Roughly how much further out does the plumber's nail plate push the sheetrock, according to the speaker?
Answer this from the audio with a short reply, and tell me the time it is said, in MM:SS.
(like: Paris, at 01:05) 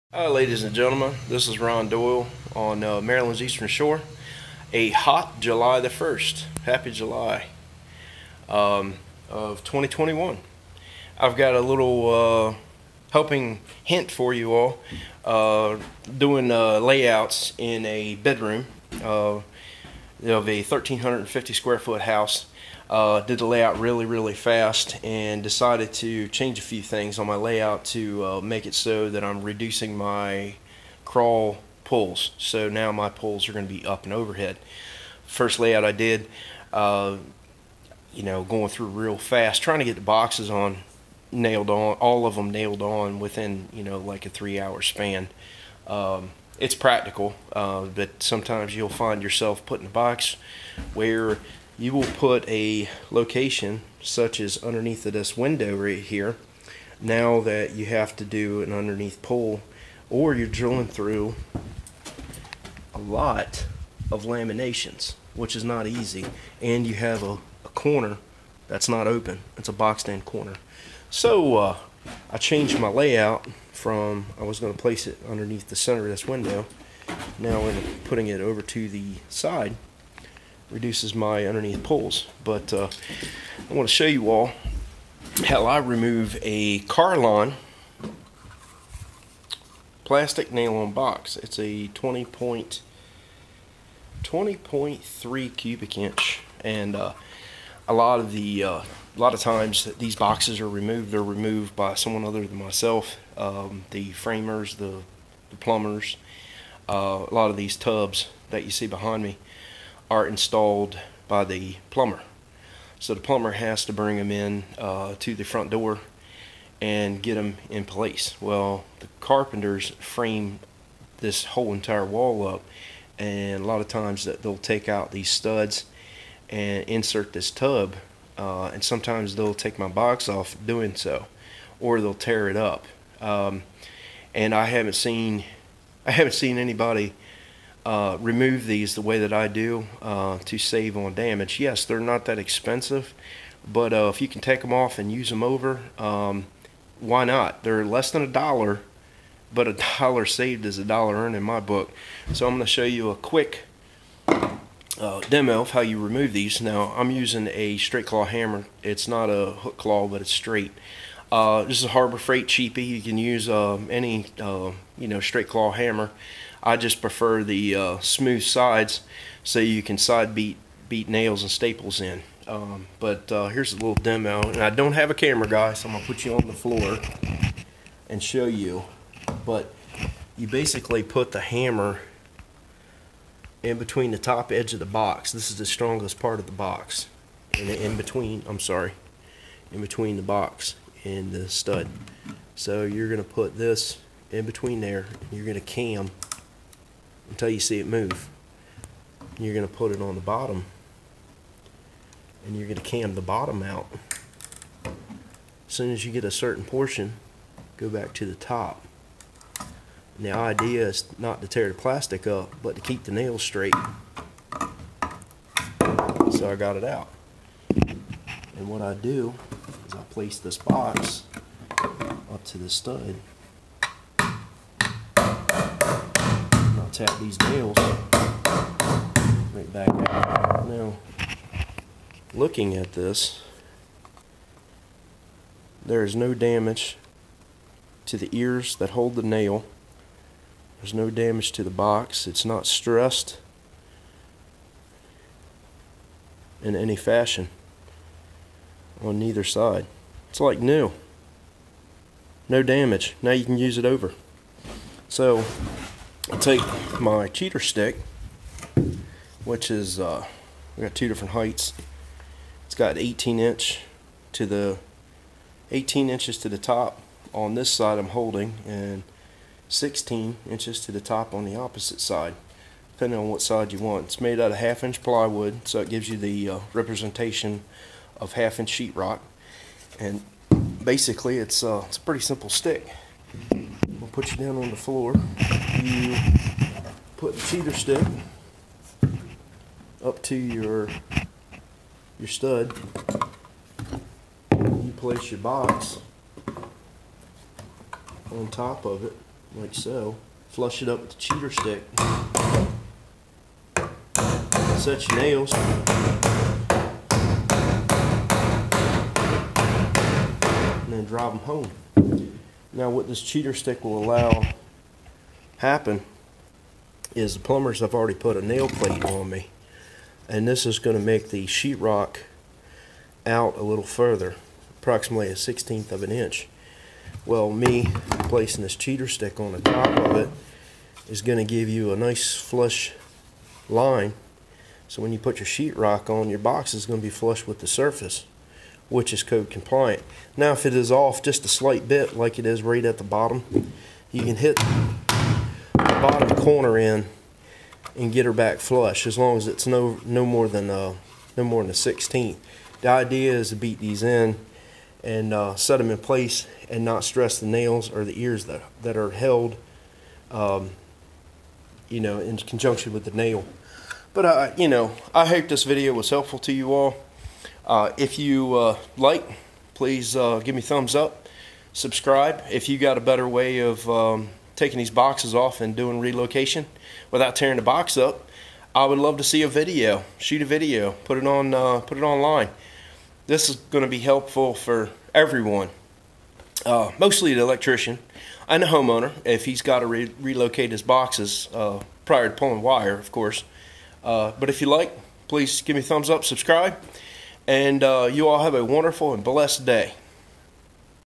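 a sixteenth of an inch, at 05:25.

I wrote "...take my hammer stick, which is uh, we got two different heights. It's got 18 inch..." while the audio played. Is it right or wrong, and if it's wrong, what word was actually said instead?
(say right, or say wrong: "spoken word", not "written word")
wrong: "cheater", not "hammer".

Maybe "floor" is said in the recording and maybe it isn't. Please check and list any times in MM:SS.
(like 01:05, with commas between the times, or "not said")
02:56, 04:44.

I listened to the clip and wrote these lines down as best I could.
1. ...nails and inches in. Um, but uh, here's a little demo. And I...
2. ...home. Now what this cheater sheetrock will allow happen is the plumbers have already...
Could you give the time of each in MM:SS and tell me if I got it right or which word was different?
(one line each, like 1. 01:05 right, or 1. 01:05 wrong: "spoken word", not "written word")
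1. 02:51 wrong: "staples", not "inches"
2. 05:11 wrong: "stick", not "sheetrock".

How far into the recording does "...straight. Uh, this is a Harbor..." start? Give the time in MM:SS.
02:40.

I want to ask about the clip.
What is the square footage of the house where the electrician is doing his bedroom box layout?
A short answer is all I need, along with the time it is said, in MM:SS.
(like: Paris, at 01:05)
1,350, at 00:20.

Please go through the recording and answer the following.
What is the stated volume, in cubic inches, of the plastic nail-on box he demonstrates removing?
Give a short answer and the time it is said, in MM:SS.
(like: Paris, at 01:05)
20.3, at 01:34.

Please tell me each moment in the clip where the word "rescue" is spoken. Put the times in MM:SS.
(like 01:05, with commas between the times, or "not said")
not said.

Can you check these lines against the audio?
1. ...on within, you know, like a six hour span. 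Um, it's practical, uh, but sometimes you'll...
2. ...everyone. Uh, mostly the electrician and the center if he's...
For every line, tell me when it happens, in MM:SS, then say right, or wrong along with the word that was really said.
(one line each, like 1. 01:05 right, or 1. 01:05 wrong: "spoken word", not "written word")
1. 00:42 wrong: "three", not "six"
2. 06:25 wrong: "homeowner", not "center".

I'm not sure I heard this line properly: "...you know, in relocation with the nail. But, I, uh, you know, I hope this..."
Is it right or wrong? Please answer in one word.
wrong.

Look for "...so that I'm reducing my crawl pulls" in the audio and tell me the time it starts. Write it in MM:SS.
00:28.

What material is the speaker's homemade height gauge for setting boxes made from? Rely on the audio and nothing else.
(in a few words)
half inch plywood.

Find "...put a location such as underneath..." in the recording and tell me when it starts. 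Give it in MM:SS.
00:52.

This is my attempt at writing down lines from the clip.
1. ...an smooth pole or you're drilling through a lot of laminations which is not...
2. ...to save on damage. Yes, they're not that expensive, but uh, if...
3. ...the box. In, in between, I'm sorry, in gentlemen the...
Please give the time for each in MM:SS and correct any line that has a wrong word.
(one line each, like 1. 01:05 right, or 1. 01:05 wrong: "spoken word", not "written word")
1. 00:58 wrong: "underneath", not "smooth"
2. 02:20 right
3. 03:06 wrong: "between", not "gentlemen".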